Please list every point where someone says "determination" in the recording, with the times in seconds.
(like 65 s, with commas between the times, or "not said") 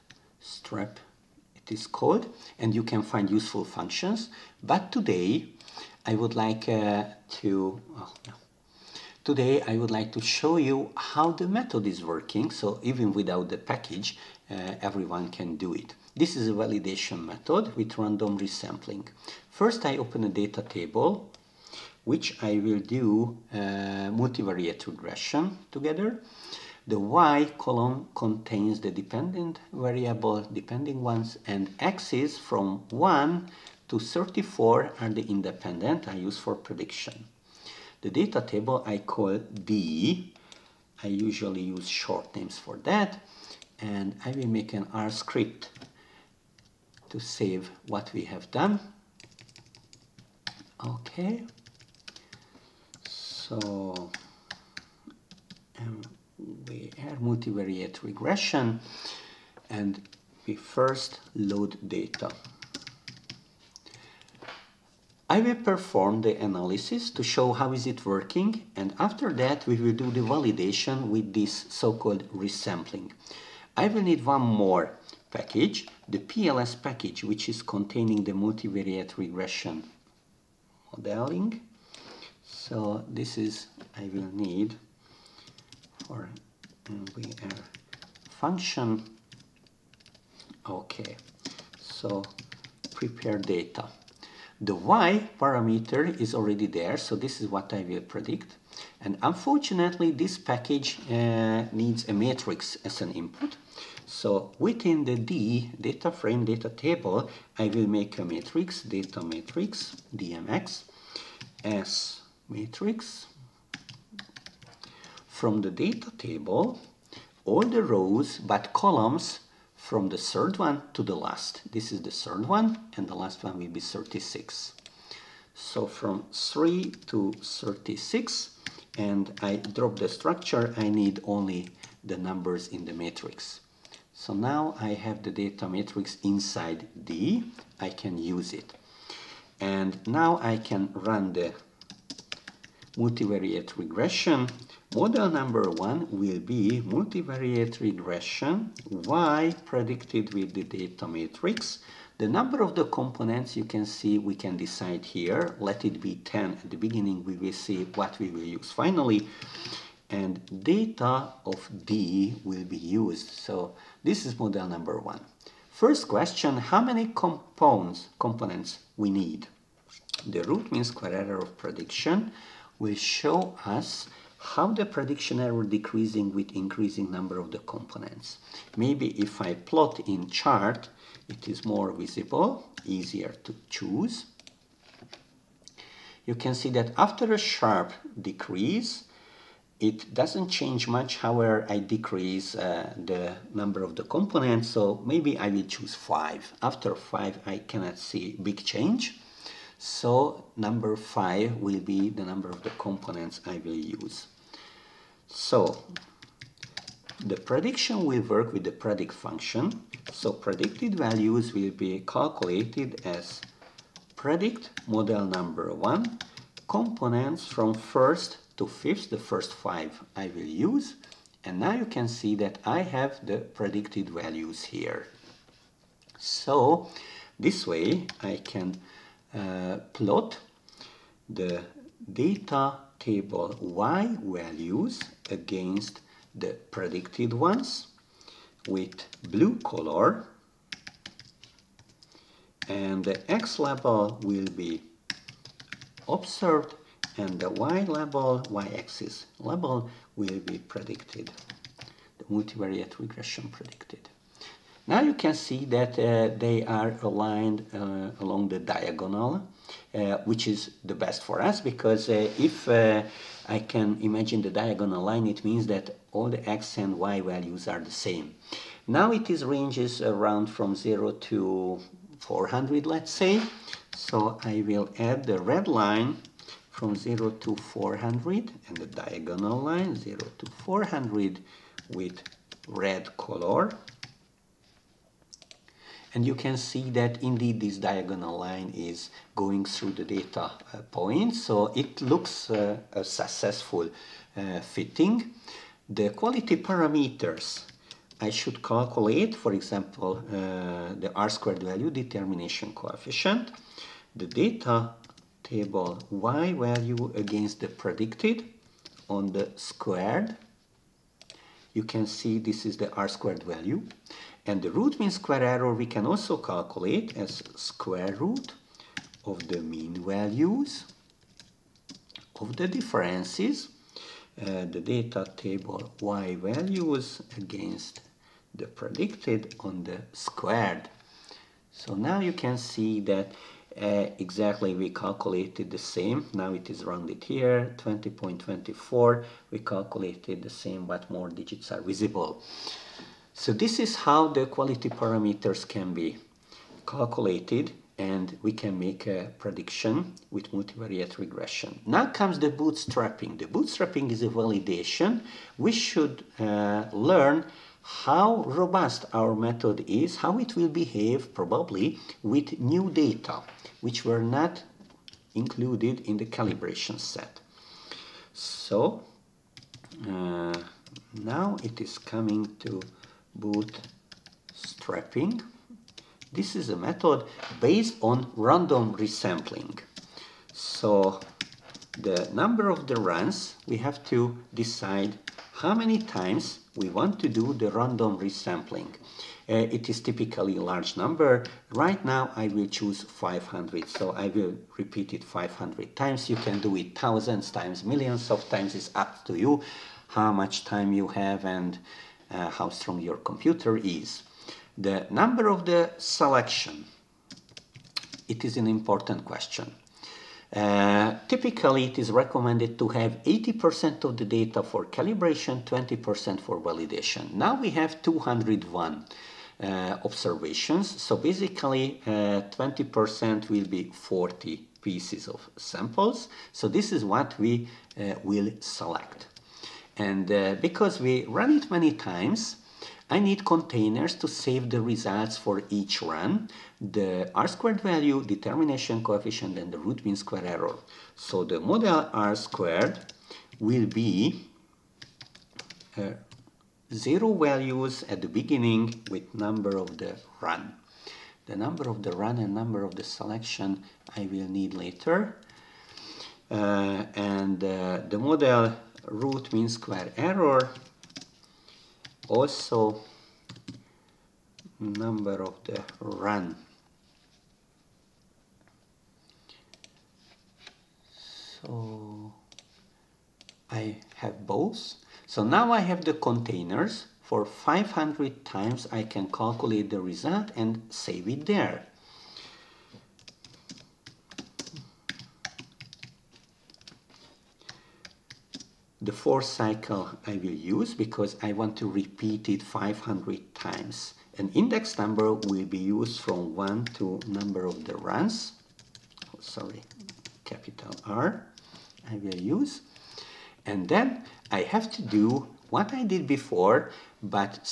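301 s, 438 s.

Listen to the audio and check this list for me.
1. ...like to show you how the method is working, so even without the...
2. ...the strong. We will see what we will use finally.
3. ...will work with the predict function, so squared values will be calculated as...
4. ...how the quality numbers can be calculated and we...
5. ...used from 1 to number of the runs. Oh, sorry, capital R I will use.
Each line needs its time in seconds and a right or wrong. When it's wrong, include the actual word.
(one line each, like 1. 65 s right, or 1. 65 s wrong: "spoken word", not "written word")
1. 9 s right
2. 156 s wrong: "beginning", not "strong"
3. 208 s wrong: "predicted", not "squared"
4. 343 s wrong: "parameters", not "numbers"
5. 495 s right.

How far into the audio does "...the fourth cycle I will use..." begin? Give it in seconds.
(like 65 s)
489 s.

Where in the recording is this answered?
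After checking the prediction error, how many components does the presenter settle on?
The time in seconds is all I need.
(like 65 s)
200 s.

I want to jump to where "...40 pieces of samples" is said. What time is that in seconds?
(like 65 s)
423 s.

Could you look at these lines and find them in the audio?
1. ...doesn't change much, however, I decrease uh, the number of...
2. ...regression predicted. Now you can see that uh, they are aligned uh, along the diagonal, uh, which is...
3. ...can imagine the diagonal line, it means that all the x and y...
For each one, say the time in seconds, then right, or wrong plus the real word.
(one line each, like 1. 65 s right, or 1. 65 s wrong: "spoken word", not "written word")
1. 190 s right
2. 252 s right
3. 263 s right.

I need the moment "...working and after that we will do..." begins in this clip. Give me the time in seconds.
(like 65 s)
68 s.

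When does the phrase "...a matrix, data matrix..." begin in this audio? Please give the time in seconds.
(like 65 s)
108 s.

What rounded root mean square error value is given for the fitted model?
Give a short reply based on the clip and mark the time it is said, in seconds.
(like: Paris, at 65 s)
20.24, at 337 s.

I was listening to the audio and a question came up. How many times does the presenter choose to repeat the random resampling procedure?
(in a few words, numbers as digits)
500.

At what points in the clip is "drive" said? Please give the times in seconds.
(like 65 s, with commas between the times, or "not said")
not said.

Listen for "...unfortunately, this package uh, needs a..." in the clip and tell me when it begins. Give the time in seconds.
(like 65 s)
99 s.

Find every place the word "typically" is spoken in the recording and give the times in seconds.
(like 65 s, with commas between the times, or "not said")
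390 s, 411 s.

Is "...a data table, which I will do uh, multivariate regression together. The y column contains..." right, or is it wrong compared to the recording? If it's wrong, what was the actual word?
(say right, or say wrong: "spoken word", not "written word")
right.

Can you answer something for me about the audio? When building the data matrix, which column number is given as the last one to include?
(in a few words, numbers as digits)
36.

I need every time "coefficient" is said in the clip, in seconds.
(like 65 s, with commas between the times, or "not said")
302 s, 439 s.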